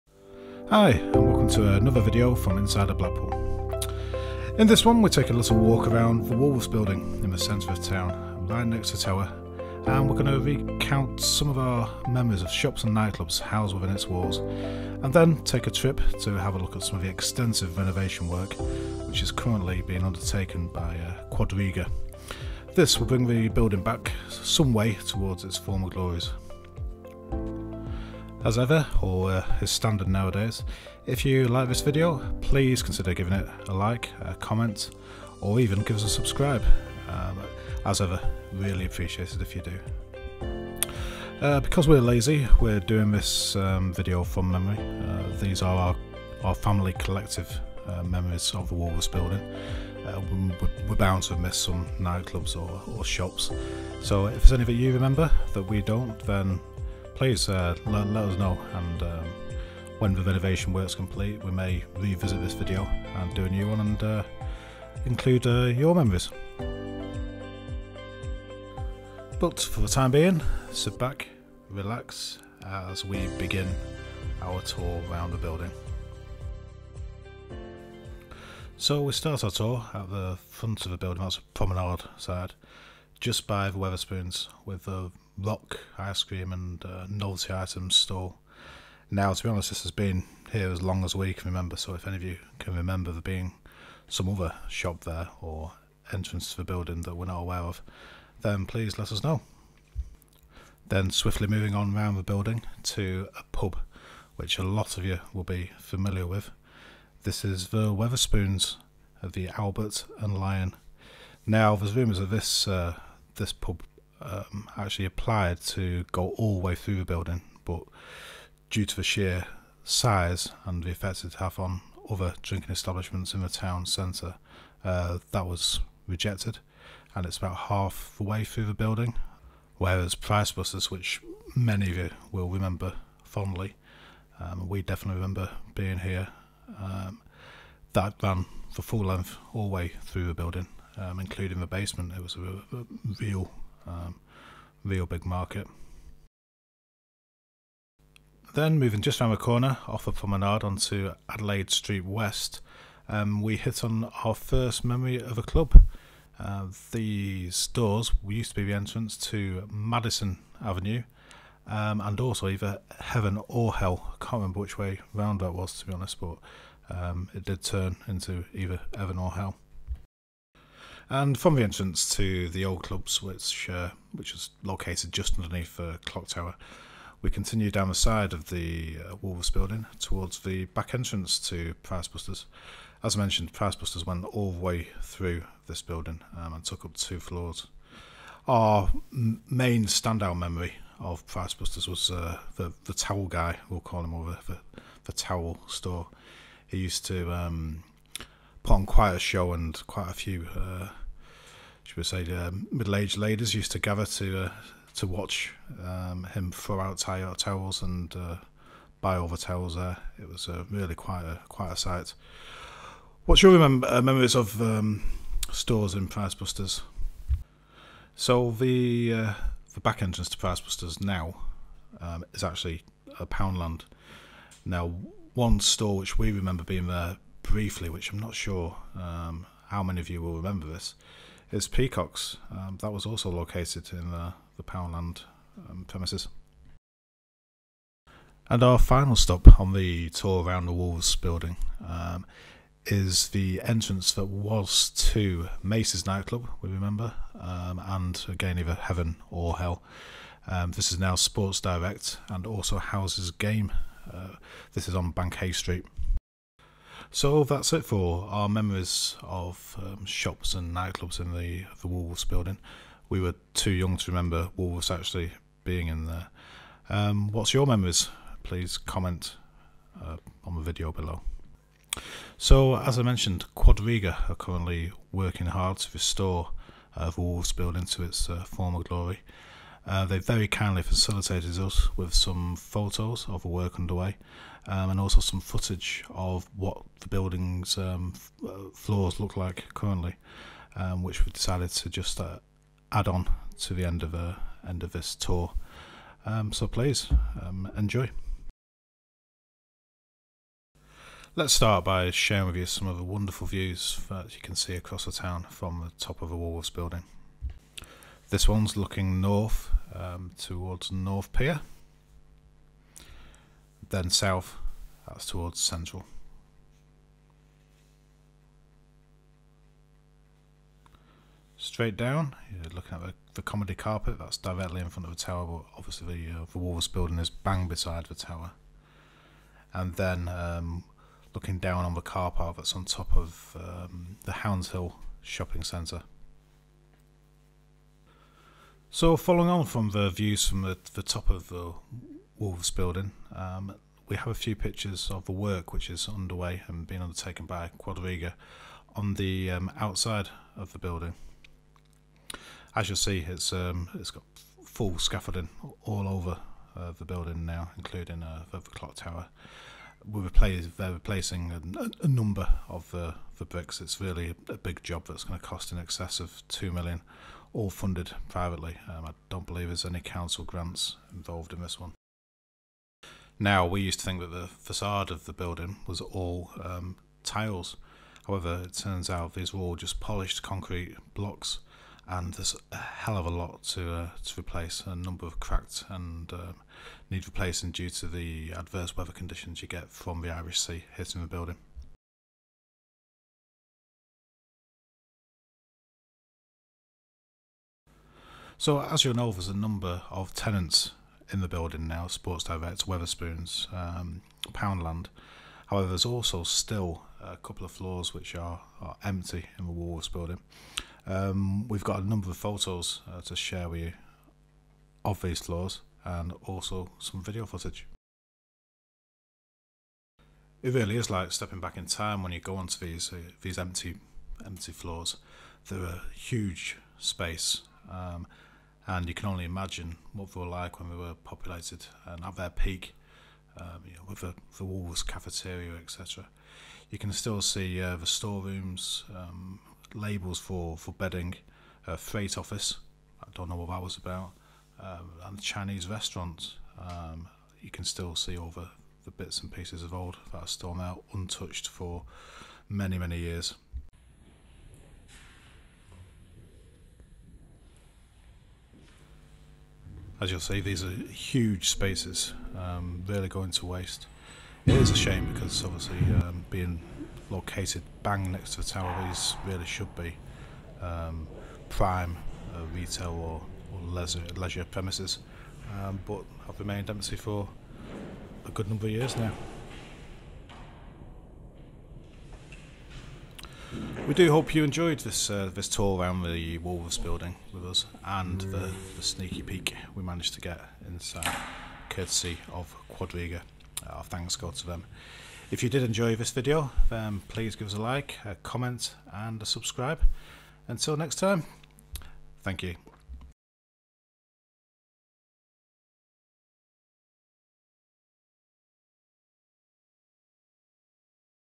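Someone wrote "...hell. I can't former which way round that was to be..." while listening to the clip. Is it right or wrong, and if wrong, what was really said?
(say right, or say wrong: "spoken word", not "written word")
wrong: "remember", not "former".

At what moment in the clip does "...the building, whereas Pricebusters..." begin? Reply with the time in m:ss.
2:08.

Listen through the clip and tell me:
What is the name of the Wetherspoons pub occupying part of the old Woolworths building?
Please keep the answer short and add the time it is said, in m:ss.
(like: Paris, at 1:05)
Albert and Lion, at 1:49.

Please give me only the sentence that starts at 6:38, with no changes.
So, as you'll know, there's a number of tenants in the building now, Sports Direct, Wetherspoons, um, Poundland.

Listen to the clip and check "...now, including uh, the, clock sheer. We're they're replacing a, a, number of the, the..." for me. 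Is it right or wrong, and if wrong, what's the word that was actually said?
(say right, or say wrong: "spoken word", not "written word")
wrong: "tower", not "sheer".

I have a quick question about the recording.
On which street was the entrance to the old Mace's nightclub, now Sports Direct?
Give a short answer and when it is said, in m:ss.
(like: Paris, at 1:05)
Bank Hay Street, at 4:15.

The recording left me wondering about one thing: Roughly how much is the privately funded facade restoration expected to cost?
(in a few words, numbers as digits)
In excess of 2 million.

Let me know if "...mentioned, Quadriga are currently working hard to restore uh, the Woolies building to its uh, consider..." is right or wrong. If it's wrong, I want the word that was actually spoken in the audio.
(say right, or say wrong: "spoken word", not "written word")
wrong: "former", not "consider".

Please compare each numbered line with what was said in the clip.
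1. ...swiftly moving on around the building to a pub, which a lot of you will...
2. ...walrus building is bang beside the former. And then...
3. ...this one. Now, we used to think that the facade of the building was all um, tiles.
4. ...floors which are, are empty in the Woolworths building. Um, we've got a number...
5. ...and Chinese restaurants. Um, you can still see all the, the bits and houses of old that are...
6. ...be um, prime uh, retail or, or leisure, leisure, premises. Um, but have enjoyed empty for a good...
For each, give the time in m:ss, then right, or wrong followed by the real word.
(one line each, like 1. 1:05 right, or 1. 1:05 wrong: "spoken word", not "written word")
1. 1:41 right
2. 5:26 wrong: "tower", not "former"
3. 6:11 right
4. 6:47 right
5. 7:25 wrong: "pieces", not "houses"
6. 7:49 wrong: "remained", not "enjoyed".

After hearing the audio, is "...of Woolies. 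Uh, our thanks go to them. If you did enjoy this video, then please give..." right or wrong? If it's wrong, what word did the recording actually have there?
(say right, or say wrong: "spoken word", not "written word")
wrong: "Quadriga", not "Woolies".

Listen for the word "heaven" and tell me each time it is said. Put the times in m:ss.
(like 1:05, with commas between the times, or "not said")
2:42, 2:48, 4:08.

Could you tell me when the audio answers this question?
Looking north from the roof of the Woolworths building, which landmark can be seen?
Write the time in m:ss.
5:10.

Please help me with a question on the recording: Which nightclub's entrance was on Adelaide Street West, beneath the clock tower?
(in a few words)
Madison Avenue.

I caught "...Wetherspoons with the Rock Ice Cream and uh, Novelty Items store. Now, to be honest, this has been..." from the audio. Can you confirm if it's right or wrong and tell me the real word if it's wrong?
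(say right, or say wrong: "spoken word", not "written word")
right.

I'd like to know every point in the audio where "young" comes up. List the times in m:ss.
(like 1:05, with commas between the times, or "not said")
4:23.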